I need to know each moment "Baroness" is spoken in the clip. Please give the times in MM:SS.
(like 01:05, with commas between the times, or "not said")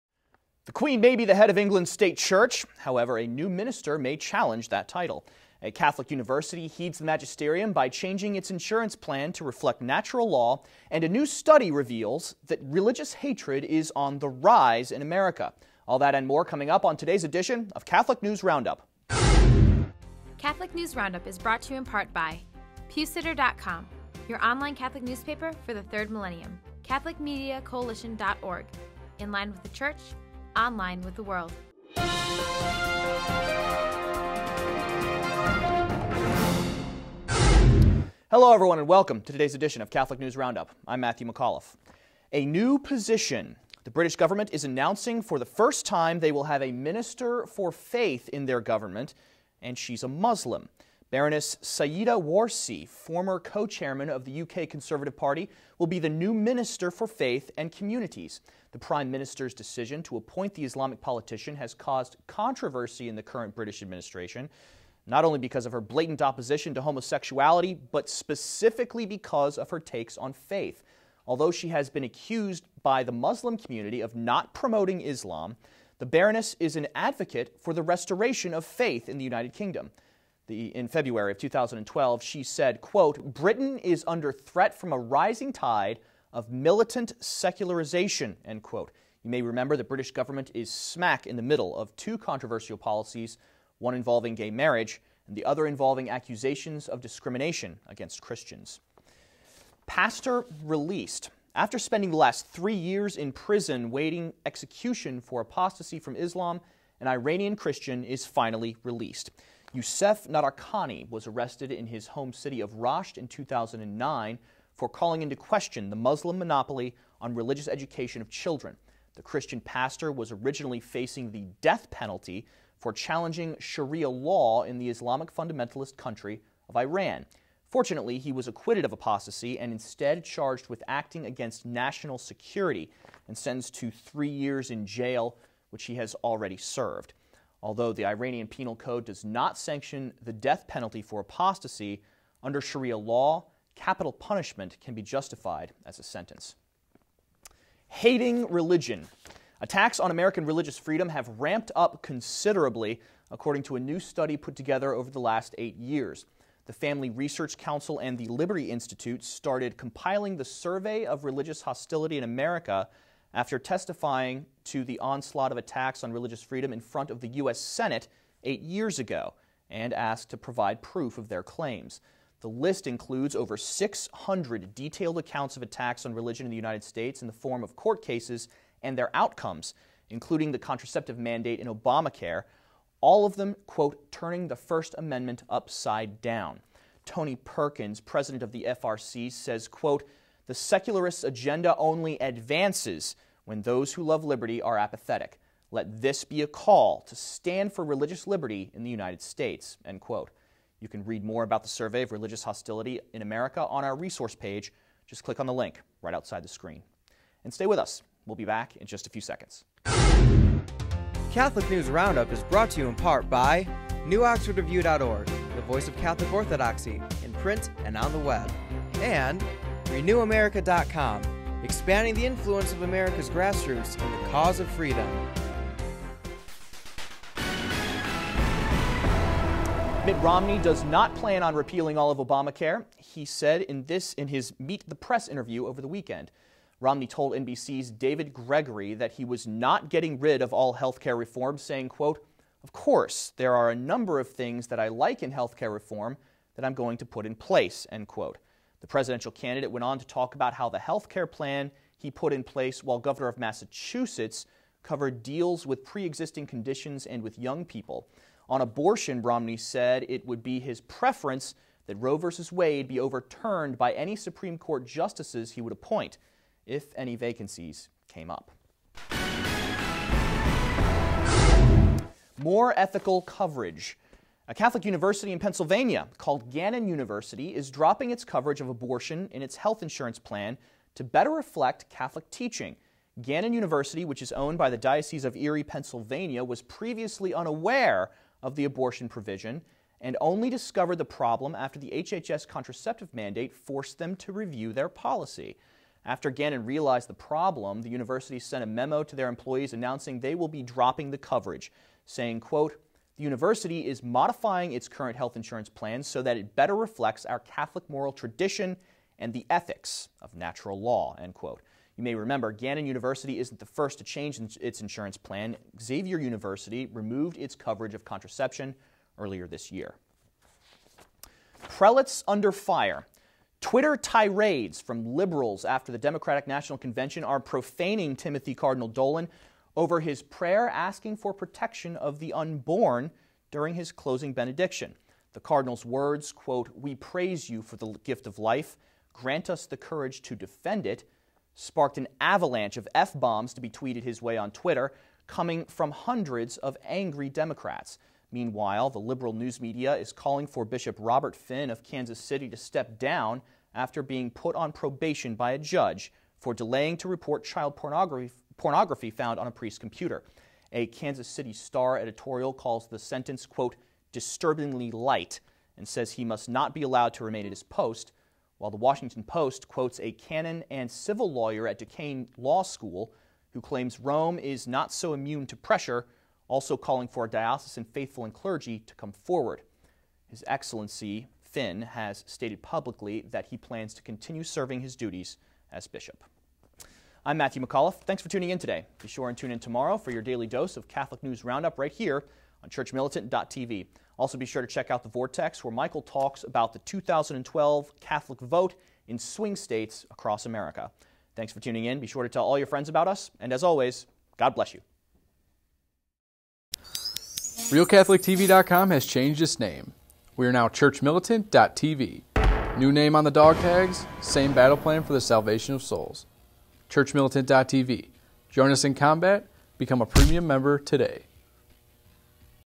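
00:51, 01:16.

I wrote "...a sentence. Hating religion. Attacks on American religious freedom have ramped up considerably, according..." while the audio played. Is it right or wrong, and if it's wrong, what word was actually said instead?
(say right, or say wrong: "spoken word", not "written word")
right.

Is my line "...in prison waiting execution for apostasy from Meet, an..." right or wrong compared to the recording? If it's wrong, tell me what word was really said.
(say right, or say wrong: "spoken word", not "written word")
wrong: "Islam", not "Meet".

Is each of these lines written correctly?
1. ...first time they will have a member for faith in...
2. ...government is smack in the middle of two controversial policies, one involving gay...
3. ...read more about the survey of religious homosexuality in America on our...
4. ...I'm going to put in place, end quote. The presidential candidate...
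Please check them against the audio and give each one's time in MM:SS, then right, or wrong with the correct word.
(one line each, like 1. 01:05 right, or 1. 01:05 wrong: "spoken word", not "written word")
1. 00:45 wrong: "minister", not "member"
2. 01:30 right
3. 03:21 wrong: "hostility", not "homosexuality"
4. 04:06 right.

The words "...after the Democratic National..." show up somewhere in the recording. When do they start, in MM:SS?
05:25.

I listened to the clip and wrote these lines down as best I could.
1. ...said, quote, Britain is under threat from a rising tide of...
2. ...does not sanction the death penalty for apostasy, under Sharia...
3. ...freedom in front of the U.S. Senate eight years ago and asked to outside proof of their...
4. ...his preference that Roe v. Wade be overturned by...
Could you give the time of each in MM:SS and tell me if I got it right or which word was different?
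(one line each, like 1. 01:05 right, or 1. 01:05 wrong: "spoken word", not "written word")
1. 01:22 right
2. 02:19 right
3. 02:46 wrong: "provide", not "outside"
4. 04:20 right.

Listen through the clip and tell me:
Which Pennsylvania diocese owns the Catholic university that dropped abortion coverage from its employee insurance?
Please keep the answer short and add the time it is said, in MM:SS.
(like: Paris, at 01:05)
Diocese of Erie, at 04:44.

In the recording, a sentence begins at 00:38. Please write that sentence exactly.
Hello, everyone, and welcome to today's edition of Catholic News Roundup.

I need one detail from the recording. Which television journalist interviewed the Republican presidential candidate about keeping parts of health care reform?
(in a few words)
David Gregory.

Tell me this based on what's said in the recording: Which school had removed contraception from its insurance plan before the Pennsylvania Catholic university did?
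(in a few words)
Xavier University.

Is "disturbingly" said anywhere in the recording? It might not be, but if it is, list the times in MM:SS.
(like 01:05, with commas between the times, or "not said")
06:04.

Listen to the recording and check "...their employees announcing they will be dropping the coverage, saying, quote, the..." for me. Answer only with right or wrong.
right.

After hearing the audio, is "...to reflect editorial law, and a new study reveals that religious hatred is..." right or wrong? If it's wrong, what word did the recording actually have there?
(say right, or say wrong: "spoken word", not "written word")
wrong: "natural", not "editorial".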